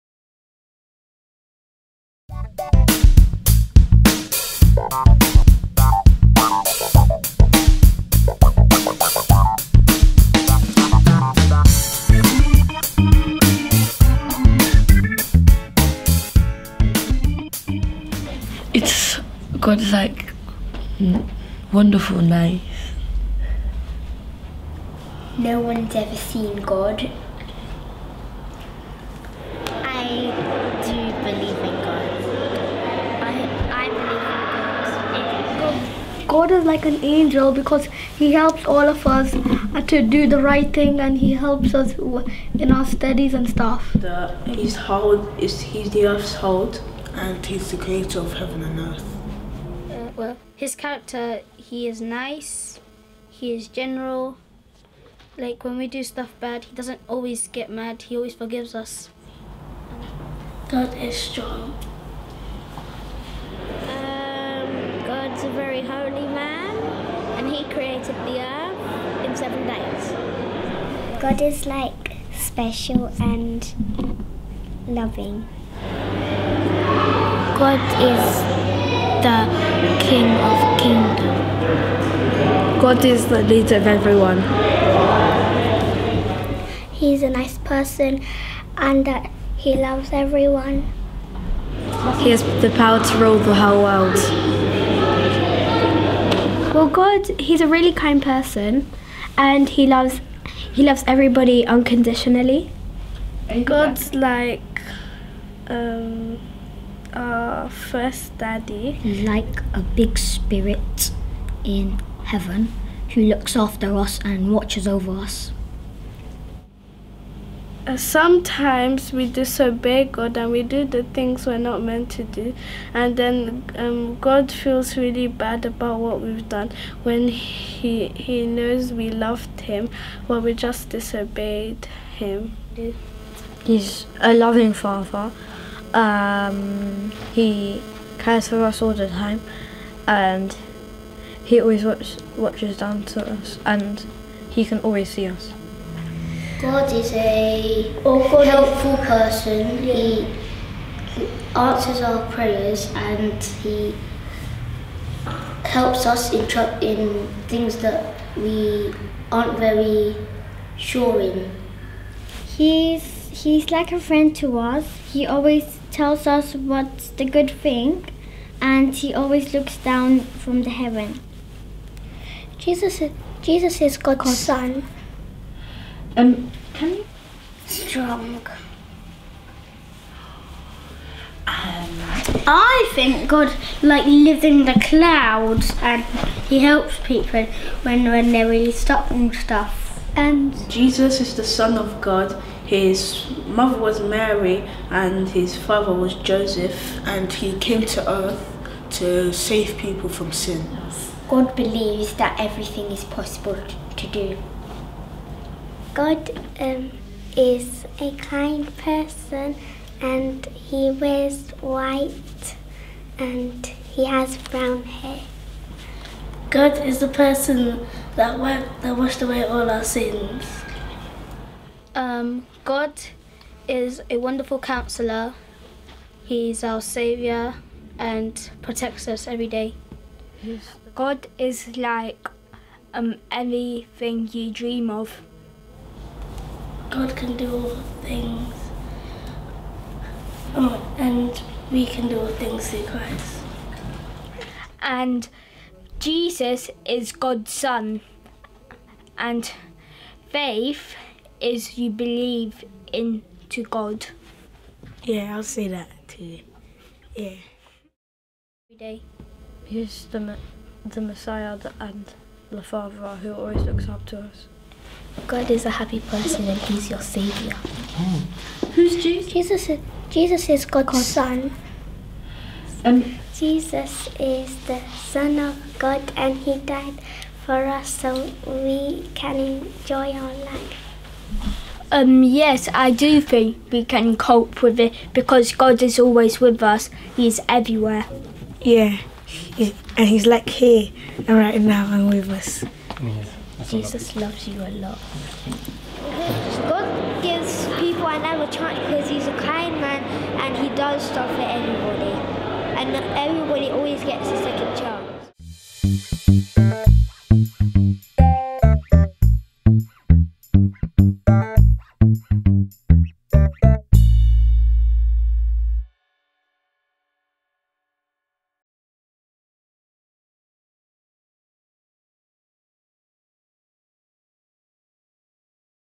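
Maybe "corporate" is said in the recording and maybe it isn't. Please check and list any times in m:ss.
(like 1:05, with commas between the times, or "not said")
not said.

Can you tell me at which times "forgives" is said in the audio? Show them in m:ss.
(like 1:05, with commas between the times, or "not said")
0:58.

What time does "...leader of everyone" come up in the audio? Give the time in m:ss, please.
1:23.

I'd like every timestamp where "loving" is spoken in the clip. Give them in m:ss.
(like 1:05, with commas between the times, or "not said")
1:14, 2:14.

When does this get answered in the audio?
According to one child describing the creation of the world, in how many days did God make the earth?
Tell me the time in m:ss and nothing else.
1:09.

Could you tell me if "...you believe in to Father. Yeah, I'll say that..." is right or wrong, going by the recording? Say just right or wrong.
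wrong.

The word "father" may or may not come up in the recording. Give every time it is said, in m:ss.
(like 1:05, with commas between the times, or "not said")
2:14, 3:15, 4:22.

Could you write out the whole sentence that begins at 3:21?
God believes that everything is possible to do.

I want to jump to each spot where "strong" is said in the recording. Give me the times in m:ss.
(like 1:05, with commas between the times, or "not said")
1:01, 2:57.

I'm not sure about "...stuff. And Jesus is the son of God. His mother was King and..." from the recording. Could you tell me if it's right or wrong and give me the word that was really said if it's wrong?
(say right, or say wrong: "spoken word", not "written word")
wrong: "Mary", not "King".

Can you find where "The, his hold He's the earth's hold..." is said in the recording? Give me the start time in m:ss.
0:43.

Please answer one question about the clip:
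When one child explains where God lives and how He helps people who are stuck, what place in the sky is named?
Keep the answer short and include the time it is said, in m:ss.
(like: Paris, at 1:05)
the clouds, at 3:04.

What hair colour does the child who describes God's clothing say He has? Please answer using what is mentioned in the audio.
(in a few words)
brown.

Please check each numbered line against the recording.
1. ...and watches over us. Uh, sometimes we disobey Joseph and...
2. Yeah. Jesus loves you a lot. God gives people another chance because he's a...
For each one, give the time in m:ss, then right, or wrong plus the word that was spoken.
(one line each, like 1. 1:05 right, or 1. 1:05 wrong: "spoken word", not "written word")
1. 1:54 wrong: "God", not "Joseph"
2. 4:53 right.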